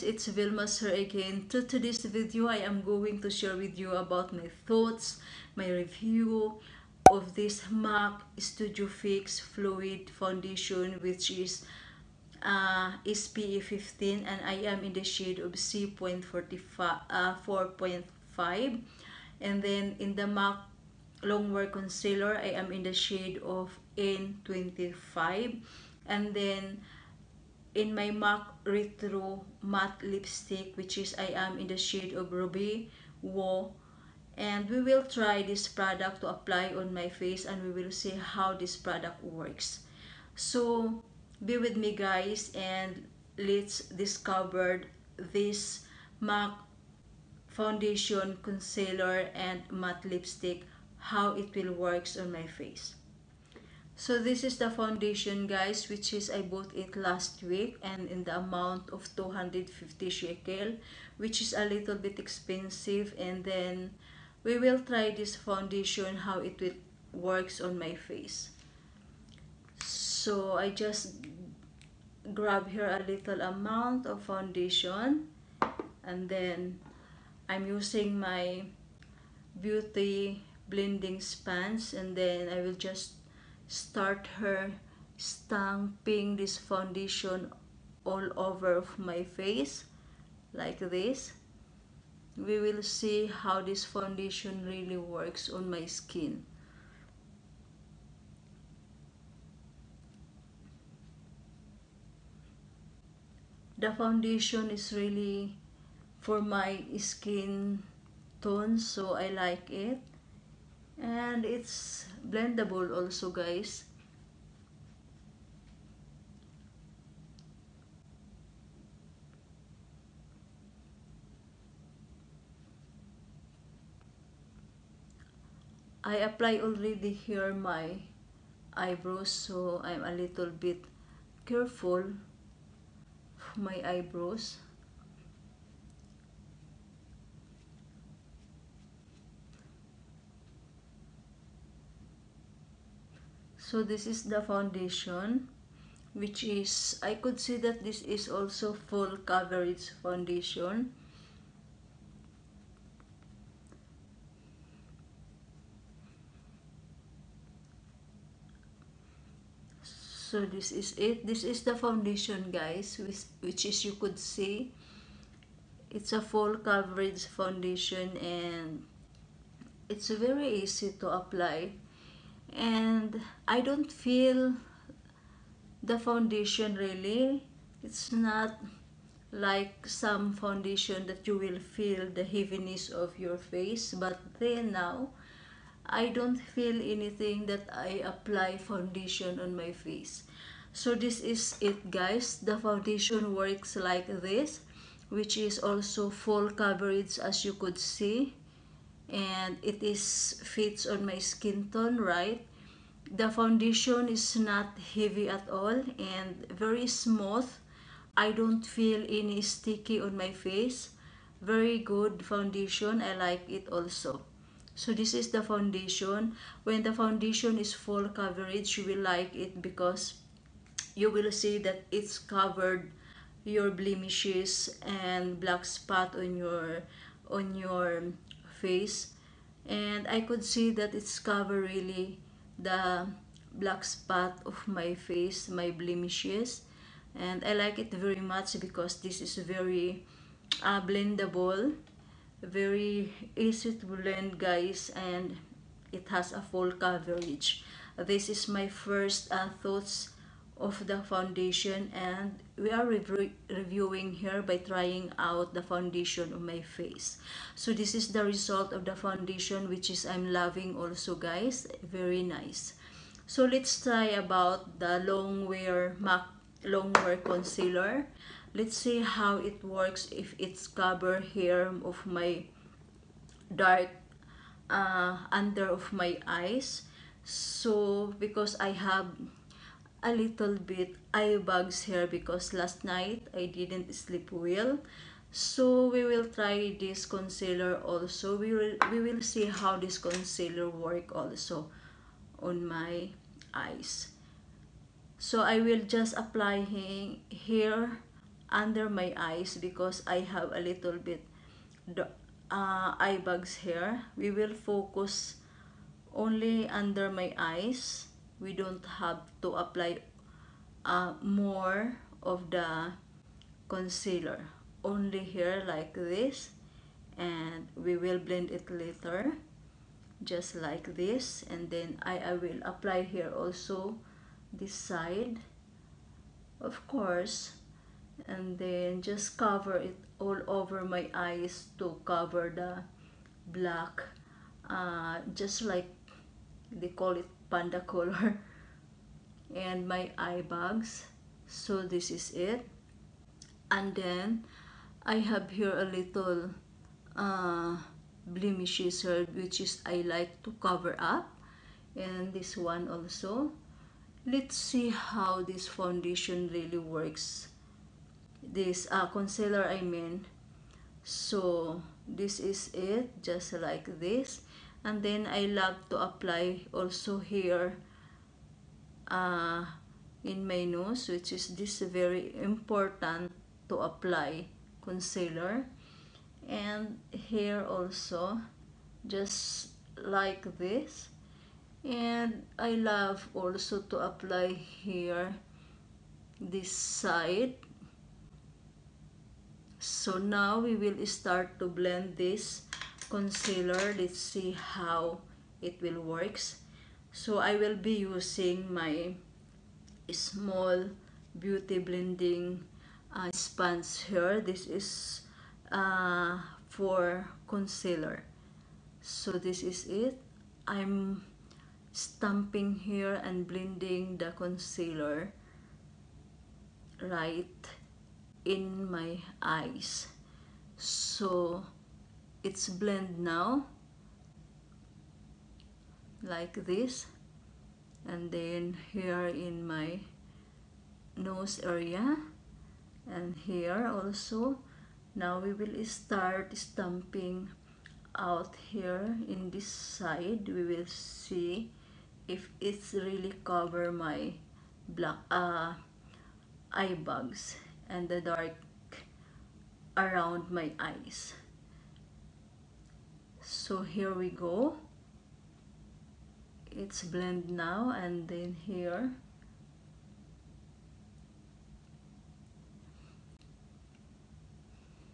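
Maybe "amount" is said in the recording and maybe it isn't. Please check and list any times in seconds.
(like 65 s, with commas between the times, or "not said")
58 s, 73 s.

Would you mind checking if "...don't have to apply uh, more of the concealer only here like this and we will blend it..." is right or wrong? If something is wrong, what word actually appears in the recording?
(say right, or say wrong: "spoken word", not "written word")
right.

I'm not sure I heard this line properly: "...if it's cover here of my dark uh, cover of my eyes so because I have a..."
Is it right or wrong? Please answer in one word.
wrong.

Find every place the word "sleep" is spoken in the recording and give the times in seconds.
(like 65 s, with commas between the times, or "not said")
283 s.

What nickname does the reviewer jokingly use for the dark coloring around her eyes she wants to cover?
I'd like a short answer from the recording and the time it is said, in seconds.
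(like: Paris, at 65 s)
panda color, at 337 s.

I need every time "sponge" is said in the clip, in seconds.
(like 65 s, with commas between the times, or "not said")
403 s.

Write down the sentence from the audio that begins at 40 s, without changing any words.
So, be with me guys and let's discover this MAC foundation, concealer, and matte lipstick, how it will works on my face.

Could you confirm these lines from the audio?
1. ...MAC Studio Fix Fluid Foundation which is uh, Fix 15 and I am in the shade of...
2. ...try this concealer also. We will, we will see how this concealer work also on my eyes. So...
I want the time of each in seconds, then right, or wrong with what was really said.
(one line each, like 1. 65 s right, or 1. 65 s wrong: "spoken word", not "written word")
1. 7 s wrong: "SPA", not "Fix"
2. 286 s right.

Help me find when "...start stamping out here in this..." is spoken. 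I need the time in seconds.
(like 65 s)
435 s.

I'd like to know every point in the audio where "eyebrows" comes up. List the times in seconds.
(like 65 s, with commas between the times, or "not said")
128 s, 133 s.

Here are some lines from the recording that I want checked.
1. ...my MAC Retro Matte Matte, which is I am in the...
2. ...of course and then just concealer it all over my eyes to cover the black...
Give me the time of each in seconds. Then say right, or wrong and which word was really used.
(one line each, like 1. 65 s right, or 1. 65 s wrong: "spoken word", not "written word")
1. 27 s wrong: "Lipstick", not "Matte"
2. 326 s wrong: "cover", not "concealer".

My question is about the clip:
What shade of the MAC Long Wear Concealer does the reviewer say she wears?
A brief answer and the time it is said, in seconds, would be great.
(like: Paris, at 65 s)
N25, at 23 s.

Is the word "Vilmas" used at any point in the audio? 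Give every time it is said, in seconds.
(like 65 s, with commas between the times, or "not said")
0 s.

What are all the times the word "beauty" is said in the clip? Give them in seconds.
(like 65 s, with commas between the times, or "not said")
79 s, 401 s.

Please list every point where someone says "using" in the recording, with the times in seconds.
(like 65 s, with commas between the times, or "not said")
77 s, 398 s.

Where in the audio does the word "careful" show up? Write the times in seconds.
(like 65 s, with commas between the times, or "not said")
131 s.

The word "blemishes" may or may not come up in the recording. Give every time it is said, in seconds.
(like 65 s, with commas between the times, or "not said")
223 s, 235 s, 348 s.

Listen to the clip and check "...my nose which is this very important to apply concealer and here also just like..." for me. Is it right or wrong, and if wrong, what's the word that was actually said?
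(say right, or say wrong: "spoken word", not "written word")
right.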